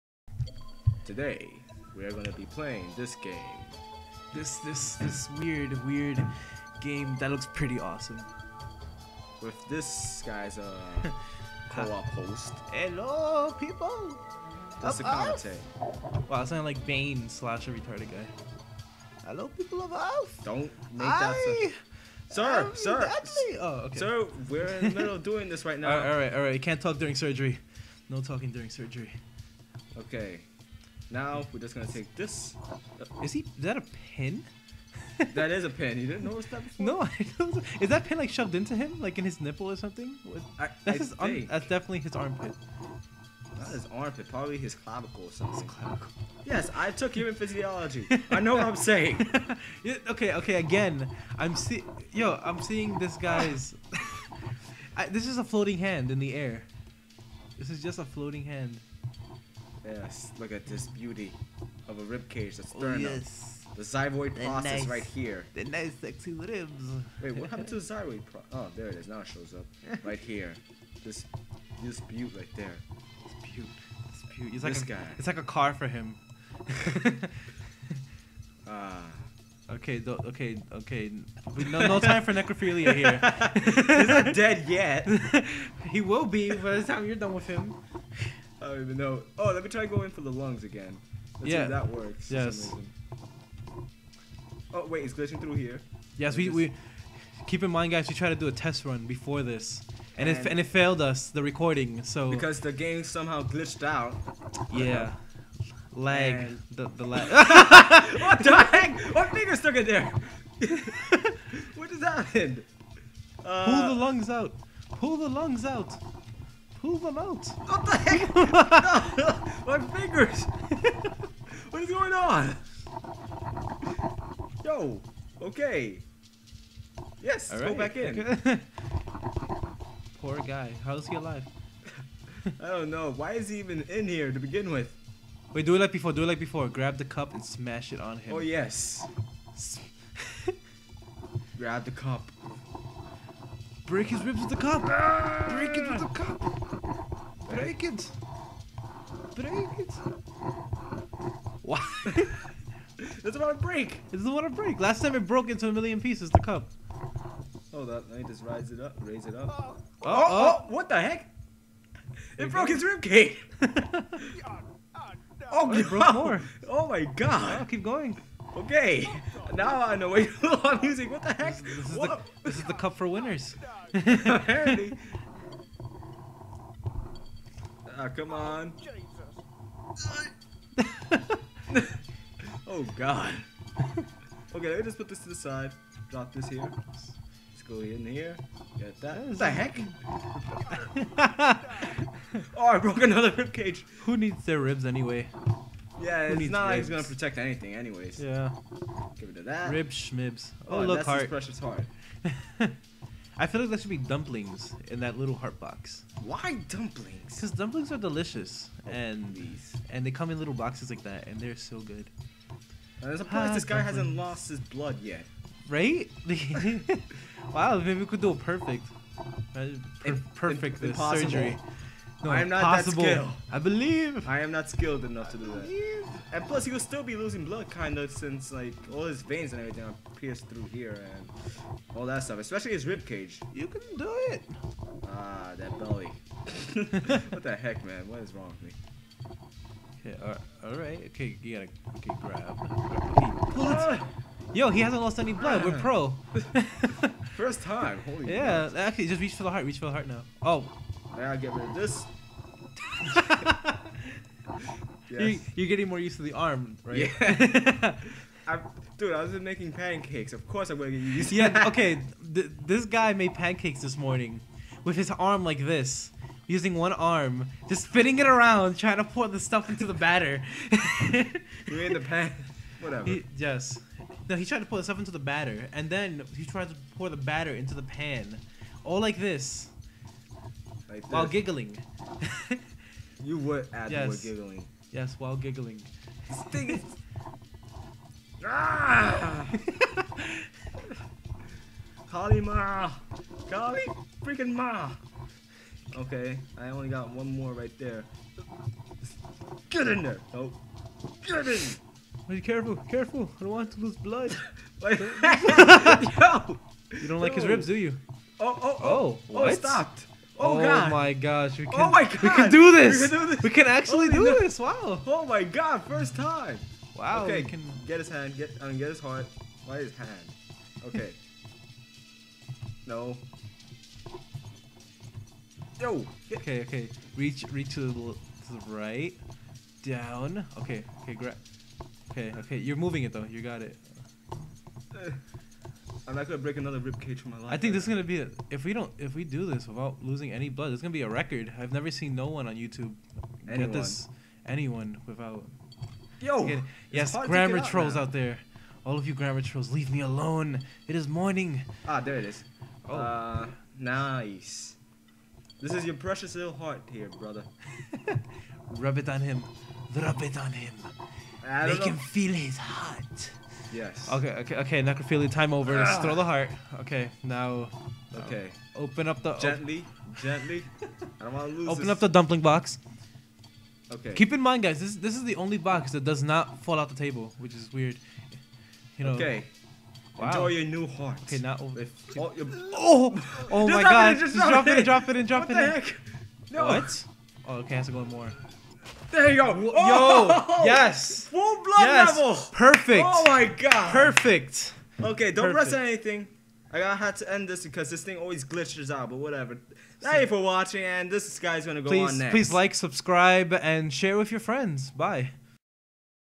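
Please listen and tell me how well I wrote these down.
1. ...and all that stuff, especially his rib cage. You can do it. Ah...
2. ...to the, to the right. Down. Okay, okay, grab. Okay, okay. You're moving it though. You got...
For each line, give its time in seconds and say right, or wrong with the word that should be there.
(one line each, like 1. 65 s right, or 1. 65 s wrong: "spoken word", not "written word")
1. 231 s right
2. 327 s right.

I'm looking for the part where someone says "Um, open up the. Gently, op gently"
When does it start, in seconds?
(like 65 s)
368 s.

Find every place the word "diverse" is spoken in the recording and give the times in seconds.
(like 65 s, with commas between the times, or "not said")
not said.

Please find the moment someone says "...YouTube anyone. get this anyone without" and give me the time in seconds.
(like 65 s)
342 s.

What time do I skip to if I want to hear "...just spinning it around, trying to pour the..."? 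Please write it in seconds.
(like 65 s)
267 s.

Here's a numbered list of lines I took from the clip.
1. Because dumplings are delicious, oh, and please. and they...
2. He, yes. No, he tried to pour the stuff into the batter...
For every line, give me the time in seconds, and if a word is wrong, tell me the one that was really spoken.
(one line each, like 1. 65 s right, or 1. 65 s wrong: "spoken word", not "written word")
1. 207 s right
2. 273 s right.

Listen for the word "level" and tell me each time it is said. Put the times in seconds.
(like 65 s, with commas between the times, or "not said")
392 s.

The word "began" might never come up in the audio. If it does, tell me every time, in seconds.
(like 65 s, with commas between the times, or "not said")
not said.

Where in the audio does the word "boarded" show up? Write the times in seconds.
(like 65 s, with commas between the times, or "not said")
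not said.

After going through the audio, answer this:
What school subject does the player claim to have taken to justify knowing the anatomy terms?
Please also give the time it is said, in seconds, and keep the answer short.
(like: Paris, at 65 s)
Human physiology, at 47 s.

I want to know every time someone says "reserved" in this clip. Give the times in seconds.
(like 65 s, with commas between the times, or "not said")
not said.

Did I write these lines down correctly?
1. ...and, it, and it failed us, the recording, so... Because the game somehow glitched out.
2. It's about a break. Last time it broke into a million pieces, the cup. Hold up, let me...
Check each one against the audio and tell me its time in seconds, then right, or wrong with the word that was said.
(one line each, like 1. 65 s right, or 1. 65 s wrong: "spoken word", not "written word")
1. 100 s right
2. 154 s right.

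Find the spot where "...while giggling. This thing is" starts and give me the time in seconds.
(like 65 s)
285 s.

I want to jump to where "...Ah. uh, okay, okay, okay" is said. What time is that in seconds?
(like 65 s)
78 s.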